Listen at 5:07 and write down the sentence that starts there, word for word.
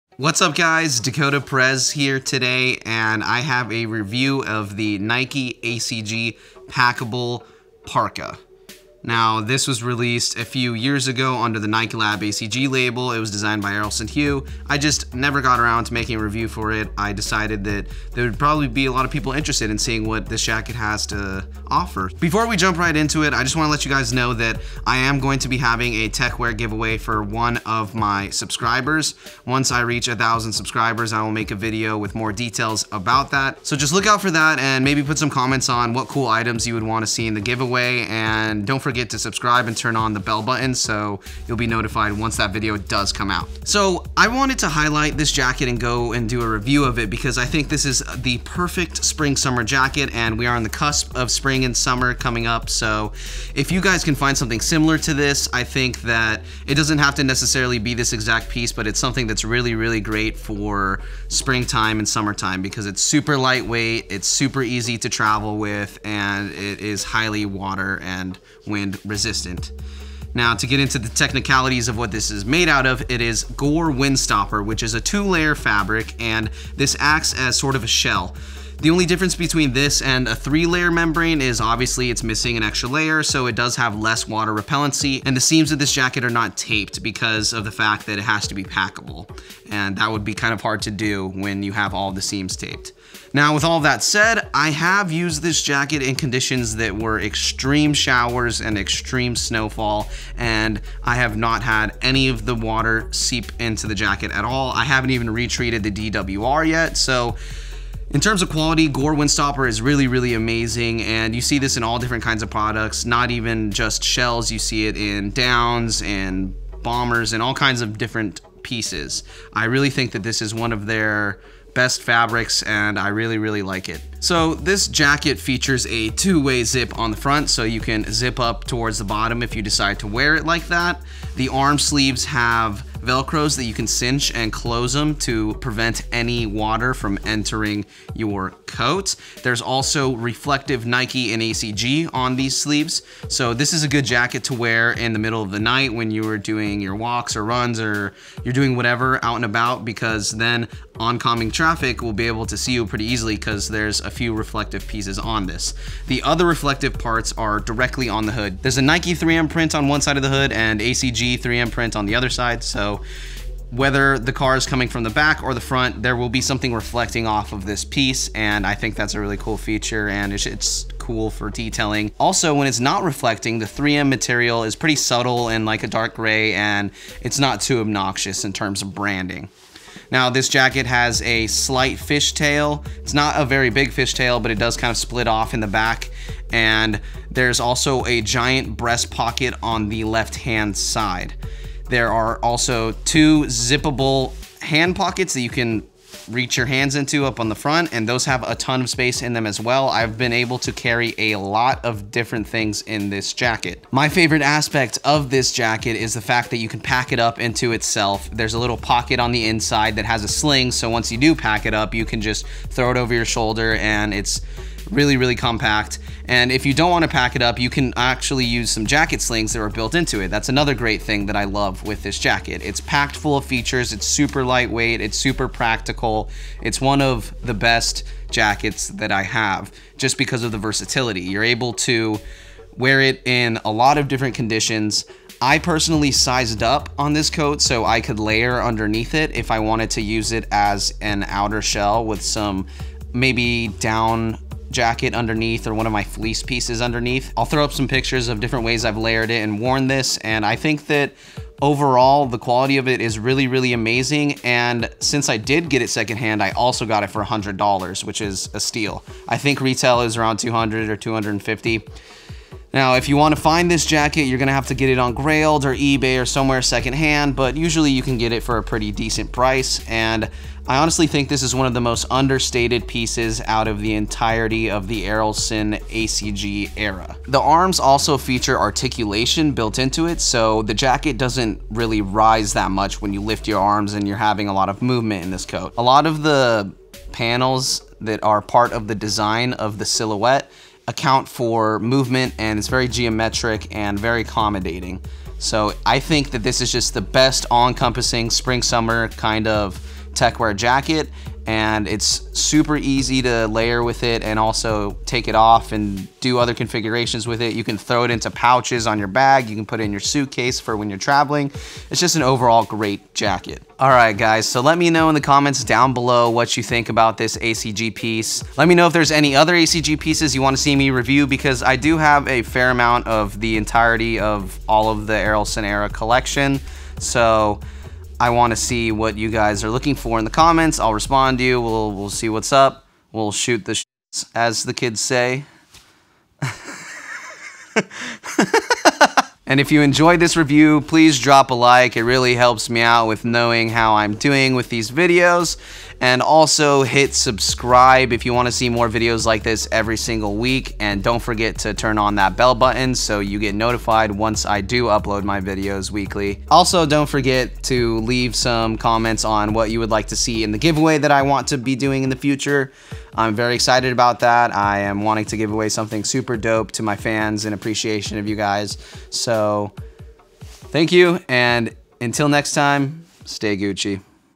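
You can throw it into pouches on your bag.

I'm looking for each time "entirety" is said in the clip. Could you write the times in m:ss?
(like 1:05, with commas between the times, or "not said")
4:33, 5:23.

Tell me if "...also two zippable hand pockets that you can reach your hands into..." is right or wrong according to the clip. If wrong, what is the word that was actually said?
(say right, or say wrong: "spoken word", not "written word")
right.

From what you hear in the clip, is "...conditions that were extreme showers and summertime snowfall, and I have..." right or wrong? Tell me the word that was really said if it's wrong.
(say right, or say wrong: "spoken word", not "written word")
wrong: "extreme", not "summertime".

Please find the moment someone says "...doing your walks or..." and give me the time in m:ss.
2:26.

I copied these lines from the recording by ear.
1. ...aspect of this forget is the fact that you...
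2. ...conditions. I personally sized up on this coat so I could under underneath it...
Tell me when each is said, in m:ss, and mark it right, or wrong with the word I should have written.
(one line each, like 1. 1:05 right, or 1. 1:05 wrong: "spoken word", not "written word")
1. 3:24 wrong: "jacket", not "forget"
2. 3:54 wrong: "layer", not "under".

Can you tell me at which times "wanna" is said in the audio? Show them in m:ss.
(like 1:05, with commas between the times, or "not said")
5:20, 5:48.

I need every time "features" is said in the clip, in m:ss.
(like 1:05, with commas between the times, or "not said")
2:05, 2:49, 3:43, 4:38.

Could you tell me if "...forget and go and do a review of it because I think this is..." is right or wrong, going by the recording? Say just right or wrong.
wrong.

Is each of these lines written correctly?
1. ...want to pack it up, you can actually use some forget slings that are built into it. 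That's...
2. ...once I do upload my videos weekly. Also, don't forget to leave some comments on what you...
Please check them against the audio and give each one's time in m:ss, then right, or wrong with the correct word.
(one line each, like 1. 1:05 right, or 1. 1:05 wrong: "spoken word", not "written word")
1. 3:36 wrong: "jacket", not "forget"
2. 5:54 right.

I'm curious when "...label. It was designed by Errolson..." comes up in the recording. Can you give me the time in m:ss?
0:12.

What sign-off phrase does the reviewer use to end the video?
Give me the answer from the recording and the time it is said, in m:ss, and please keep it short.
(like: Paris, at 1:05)
stay Gucci, at 6:13.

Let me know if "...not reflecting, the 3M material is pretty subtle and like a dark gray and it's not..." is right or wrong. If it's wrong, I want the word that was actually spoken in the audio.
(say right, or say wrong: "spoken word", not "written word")
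right.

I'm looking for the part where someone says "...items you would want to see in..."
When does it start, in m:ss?
0:36.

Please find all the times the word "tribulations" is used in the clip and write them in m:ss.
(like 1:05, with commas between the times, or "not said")
not said.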